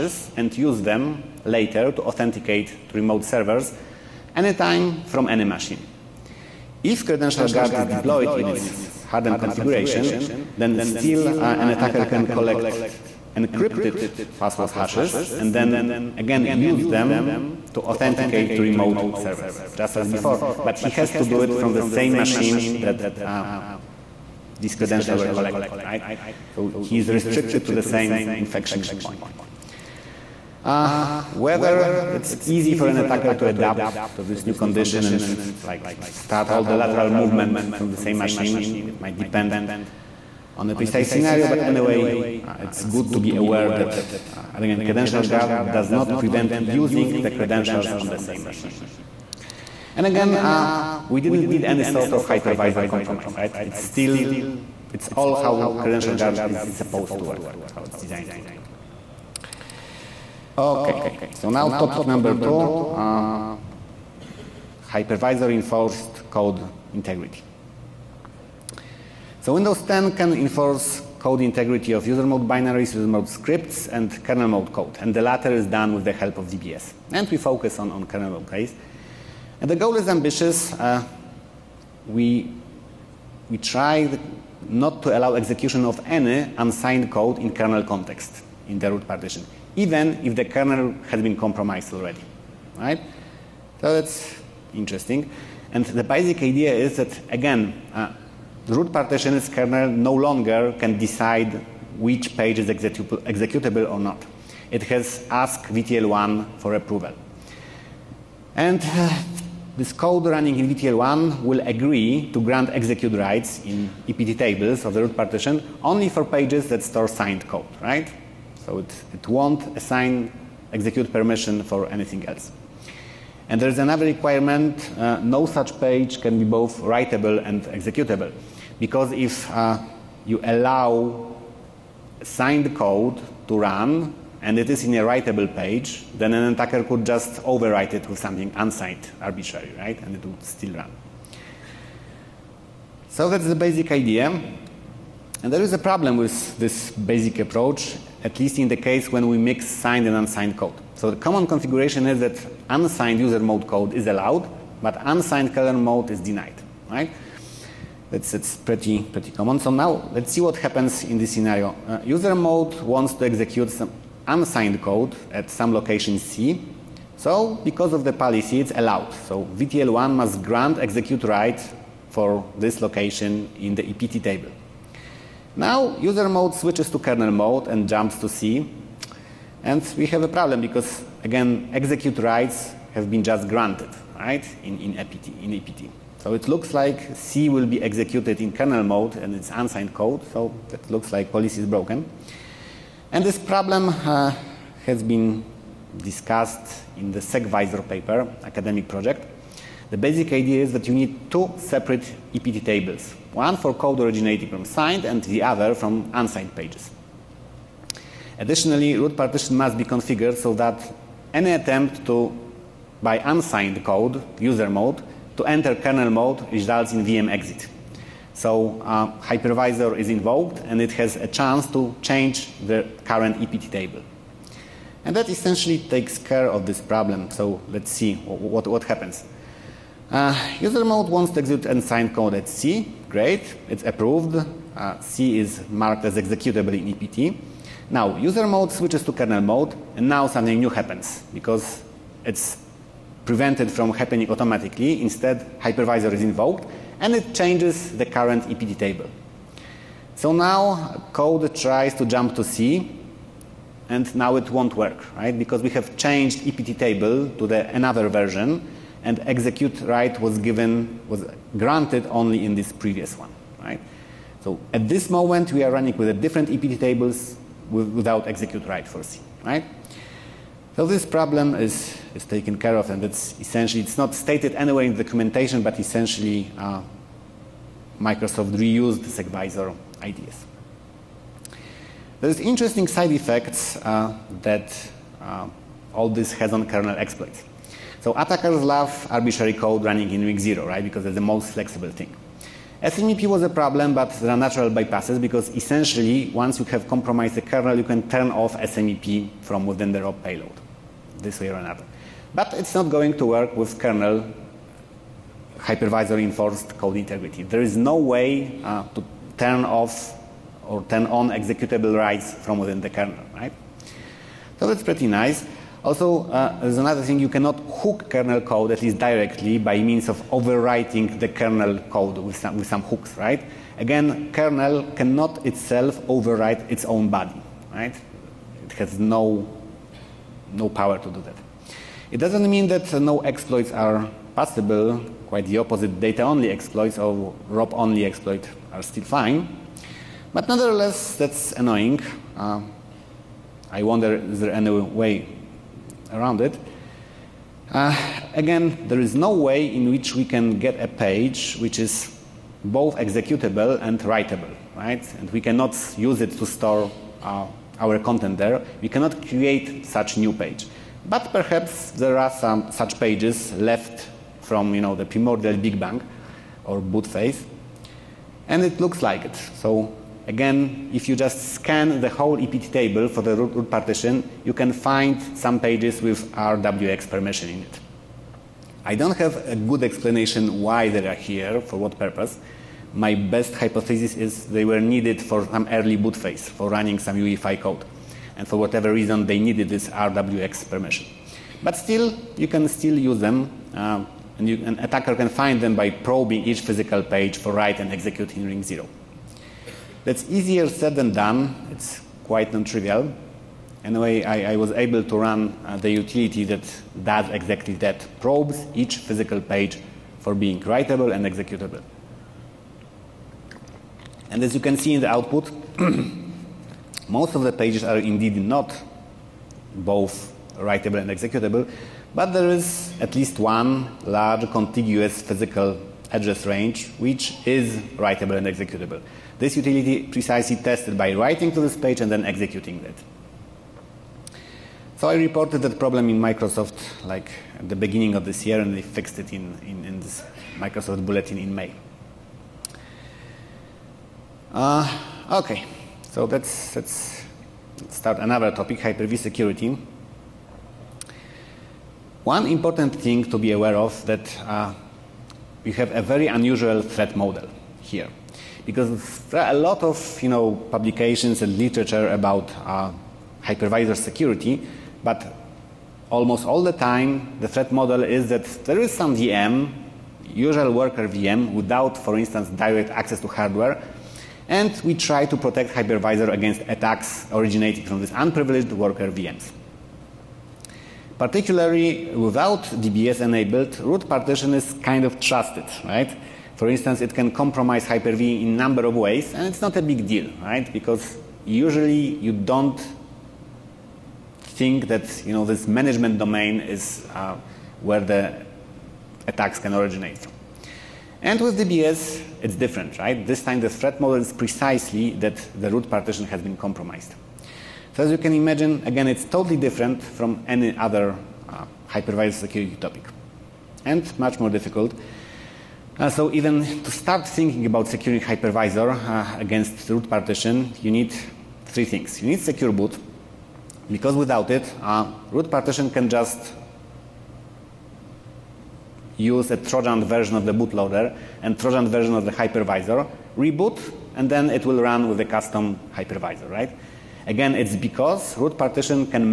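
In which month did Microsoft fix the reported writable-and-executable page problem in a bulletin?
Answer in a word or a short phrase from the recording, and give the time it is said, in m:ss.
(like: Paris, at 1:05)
May, at 7:21.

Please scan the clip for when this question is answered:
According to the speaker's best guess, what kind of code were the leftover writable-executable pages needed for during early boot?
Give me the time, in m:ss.
6:27.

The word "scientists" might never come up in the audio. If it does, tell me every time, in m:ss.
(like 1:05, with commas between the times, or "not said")
not said.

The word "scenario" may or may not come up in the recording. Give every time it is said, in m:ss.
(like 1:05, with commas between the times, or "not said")
0:41, 2:41.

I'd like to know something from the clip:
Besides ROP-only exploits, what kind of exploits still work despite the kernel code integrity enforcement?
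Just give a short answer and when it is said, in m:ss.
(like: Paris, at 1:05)
Data-only exploits, at 5:36.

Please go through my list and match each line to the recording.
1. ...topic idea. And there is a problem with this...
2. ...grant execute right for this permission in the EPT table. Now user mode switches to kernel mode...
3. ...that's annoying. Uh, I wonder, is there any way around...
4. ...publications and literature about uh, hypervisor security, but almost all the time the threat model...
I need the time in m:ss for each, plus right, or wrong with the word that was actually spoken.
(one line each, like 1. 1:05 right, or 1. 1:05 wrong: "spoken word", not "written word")
1. 2:23 wrong: "basic", not "topic"
2. 2:50 wrong: "location", not "permission"
3. 5:41 right
4. 7:40 right.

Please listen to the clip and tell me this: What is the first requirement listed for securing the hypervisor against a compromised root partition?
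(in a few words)
Secure boot.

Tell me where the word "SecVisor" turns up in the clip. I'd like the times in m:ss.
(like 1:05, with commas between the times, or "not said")
3:17, 4:39.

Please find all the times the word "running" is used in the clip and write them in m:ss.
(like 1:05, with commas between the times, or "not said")
1:50, 4:25, 4:49, 6:26.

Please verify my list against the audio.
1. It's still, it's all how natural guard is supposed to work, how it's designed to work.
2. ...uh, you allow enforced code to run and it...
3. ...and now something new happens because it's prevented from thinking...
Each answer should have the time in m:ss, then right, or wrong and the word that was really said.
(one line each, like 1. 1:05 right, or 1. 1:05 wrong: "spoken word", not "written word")
1. 0:53 wrong: "credential", not "natural"
2. 2:09 wrong: "signed", not "enforced"
3. 3:59 wrong: "happening", not "thinking".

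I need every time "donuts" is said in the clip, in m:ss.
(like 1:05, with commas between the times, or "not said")
not said.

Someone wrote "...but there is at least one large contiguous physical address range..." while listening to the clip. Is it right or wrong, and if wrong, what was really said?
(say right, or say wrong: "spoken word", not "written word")
right.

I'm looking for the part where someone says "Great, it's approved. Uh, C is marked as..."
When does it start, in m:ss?
3:53.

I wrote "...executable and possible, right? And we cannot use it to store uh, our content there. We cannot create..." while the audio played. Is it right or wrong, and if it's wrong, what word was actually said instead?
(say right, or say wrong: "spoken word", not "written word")
wrong: "writable", not "possible".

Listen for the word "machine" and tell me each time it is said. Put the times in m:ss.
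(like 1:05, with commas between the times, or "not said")
0:05, 0:22, 0:38, 0:48.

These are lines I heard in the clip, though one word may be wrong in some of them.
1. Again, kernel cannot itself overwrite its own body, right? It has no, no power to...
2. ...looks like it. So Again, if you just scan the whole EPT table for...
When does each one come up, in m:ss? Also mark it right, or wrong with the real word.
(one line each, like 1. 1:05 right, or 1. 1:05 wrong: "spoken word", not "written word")
1. 5:23 right
2. 6:08 right.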